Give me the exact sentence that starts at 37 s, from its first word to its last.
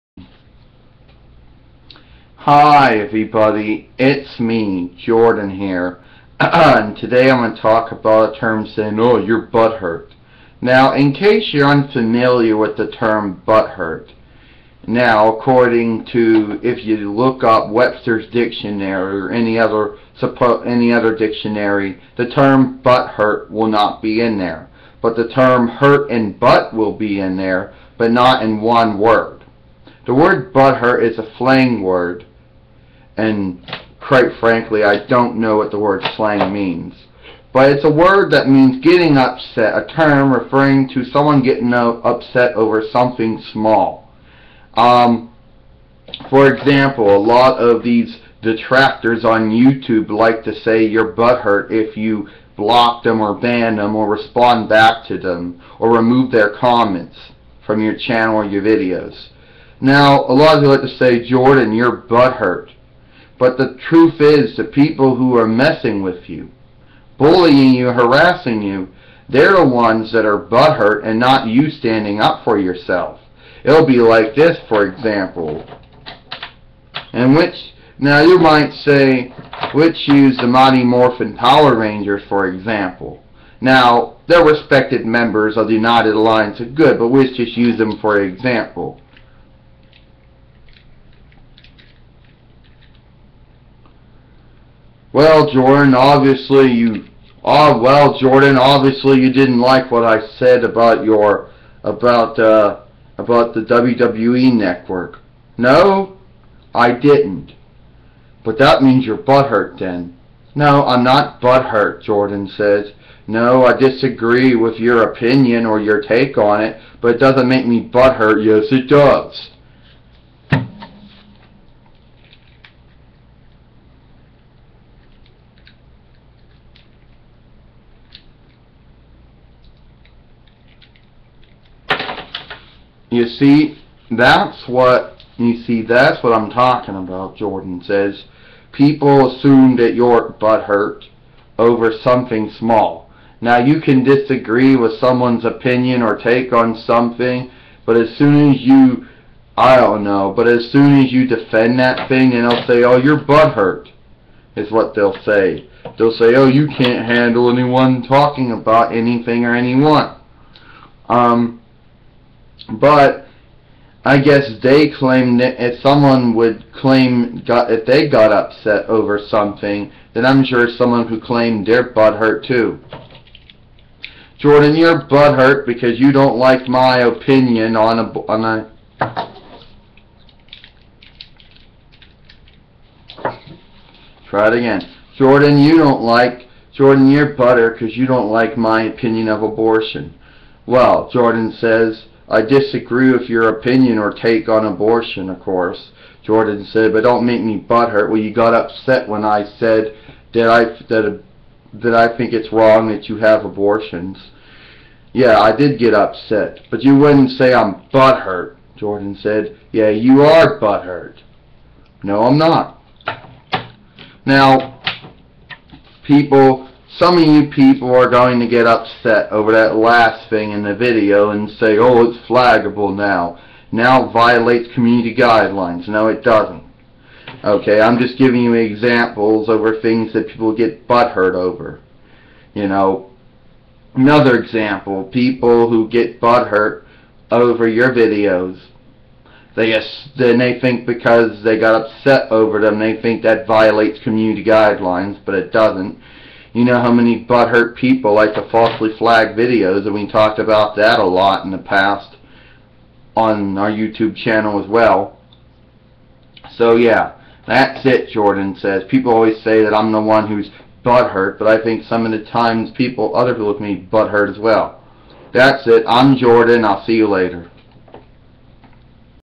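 But it's a word that means getting upset, a term referring to someone getting upset over something small.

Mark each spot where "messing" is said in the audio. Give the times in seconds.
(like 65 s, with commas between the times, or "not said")
65 s.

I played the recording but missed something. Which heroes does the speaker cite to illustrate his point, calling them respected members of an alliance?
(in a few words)
Mighty Morphin Power Rangers.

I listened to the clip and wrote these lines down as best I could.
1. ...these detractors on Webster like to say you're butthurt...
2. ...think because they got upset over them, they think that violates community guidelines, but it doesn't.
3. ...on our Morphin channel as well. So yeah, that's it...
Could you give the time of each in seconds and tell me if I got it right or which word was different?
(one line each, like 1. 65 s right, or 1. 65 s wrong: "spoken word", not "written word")
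1. 47 s wrong: "YouTube", not "Webster"
2. 240 s right
3. 253 s wrong: "YouTube", not "Morphin".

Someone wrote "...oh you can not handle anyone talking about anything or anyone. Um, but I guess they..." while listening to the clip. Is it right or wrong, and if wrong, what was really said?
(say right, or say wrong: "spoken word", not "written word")
right.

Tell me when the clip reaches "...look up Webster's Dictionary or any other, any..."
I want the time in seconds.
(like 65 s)
17 s.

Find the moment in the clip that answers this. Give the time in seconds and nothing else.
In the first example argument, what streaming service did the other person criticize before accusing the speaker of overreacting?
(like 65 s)
103 s.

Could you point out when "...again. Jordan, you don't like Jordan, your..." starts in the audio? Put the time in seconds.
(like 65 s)
184 s.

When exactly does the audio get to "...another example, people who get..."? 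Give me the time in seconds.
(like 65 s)
233 s.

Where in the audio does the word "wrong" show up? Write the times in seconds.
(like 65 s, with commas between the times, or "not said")
202 s.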